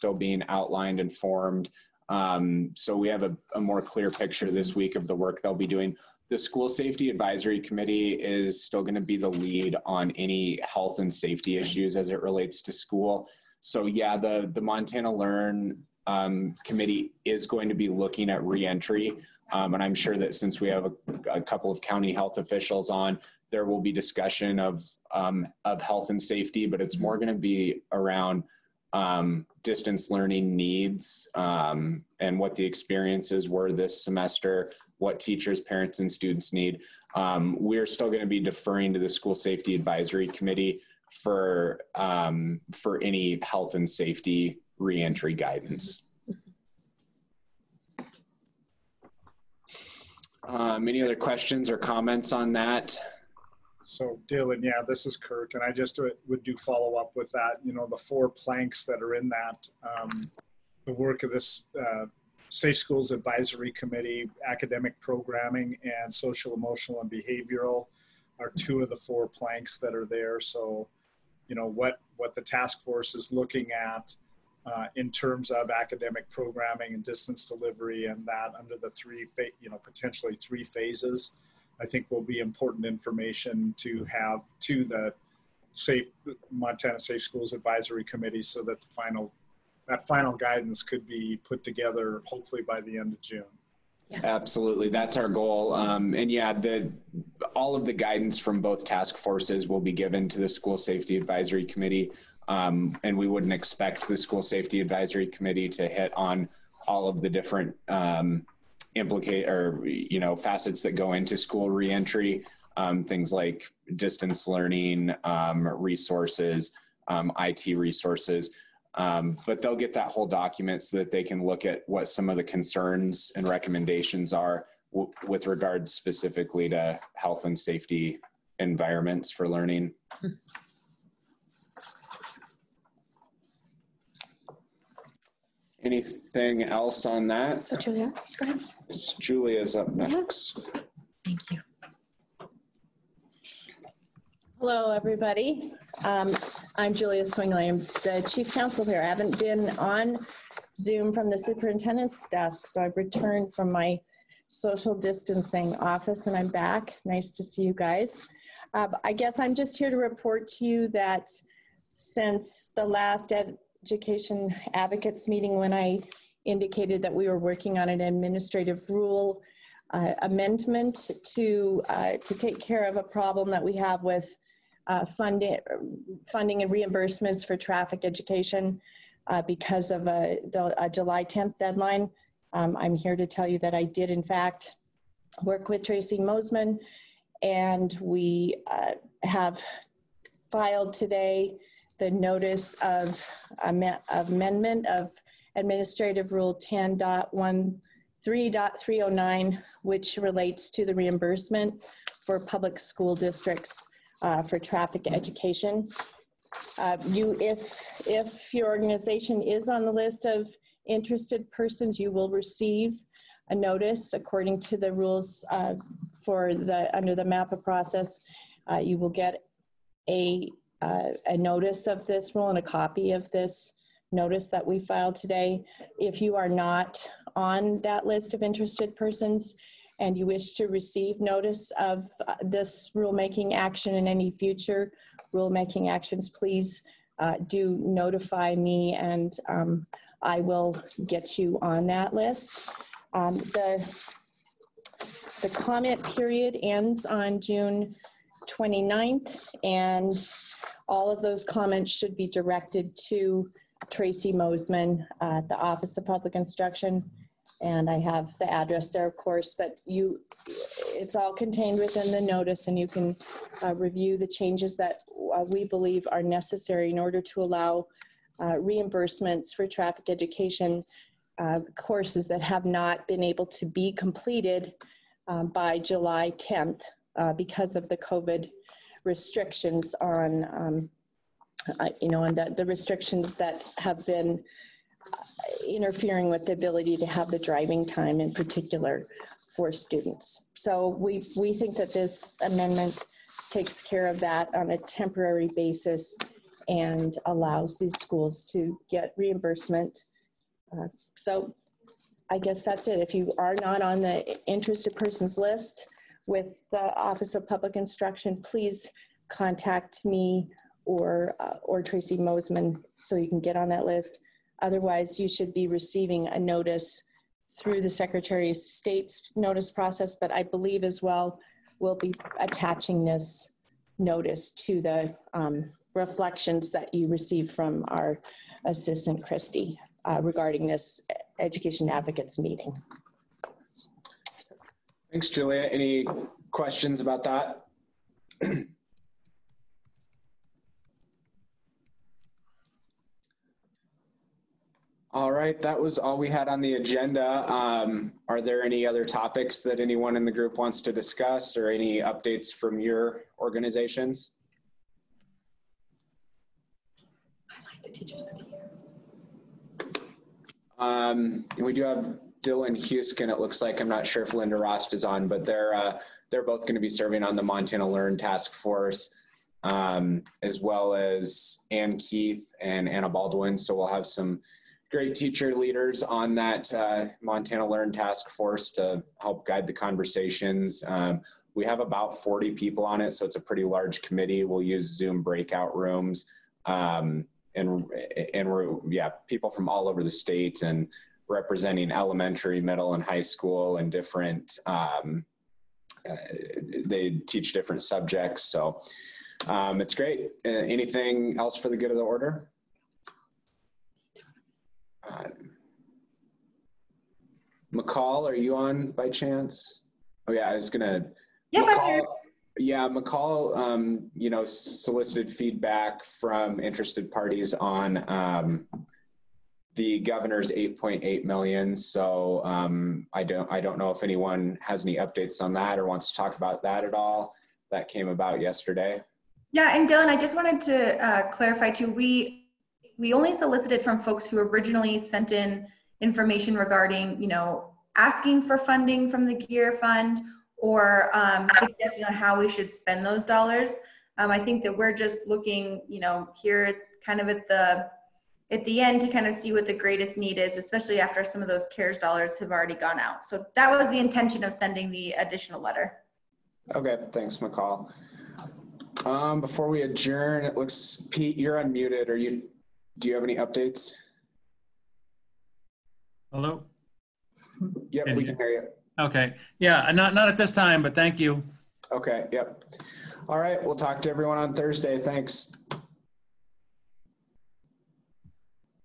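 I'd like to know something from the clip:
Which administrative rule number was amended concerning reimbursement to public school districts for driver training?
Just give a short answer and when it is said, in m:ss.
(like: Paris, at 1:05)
10.13.309, at 3:16.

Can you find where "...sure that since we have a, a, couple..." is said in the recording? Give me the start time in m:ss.
0:19.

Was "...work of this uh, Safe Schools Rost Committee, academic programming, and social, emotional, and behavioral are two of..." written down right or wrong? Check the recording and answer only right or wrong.
wrong.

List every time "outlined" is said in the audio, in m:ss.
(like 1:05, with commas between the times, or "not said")
0:00.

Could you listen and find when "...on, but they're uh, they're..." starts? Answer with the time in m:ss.
6:05.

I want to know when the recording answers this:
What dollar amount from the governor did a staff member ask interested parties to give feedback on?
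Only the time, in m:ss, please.
7:00.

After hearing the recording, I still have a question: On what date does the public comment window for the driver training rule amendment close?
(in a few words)
June 29th.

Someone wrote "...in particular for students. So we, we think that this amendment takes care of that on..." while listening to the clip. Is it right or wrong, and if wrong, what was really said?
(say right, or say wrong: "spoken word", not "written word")
right.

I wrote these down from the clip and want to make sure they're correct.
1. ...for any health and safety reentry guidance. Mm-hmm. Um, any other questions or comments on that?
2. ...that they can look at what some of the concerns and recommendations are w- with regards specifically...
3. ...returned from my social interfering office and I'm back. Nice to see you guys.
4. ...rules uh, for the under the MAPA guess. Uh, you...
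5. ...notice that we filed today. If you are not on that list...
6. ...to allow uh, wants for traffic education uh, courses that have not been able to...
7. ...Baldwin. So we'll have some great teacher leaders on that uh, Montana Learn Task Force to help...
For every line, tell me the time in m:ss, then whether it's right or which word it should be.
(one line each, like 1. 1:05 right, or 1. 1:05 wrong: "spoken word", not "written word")
1. 0:42 right
2. 2:00 right
3. 2:32 wrong: "distancing", not "interfering"
4. 3:34 wrong: "process", not "guess"
5. 3:44 right
6. 4:27 wrong: "reimbursements", not "wants"
7. 6:13 right.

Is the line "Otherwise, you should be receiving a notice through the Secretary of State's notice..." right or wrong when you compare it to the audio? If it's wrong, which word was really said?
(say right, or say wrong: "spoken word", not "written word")
right.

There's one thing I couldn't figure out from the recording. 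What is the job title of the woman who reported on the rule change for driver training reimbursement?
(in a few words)
Chief counsel.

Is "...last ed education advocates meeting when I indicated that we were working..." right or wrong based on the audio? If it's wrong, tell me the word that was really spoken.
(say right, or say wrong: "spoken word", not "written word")
right.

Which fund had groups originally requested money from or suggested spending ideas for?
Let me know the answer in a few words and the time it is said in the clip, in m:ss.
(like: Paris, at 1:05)
GEER Fund, at 7:19.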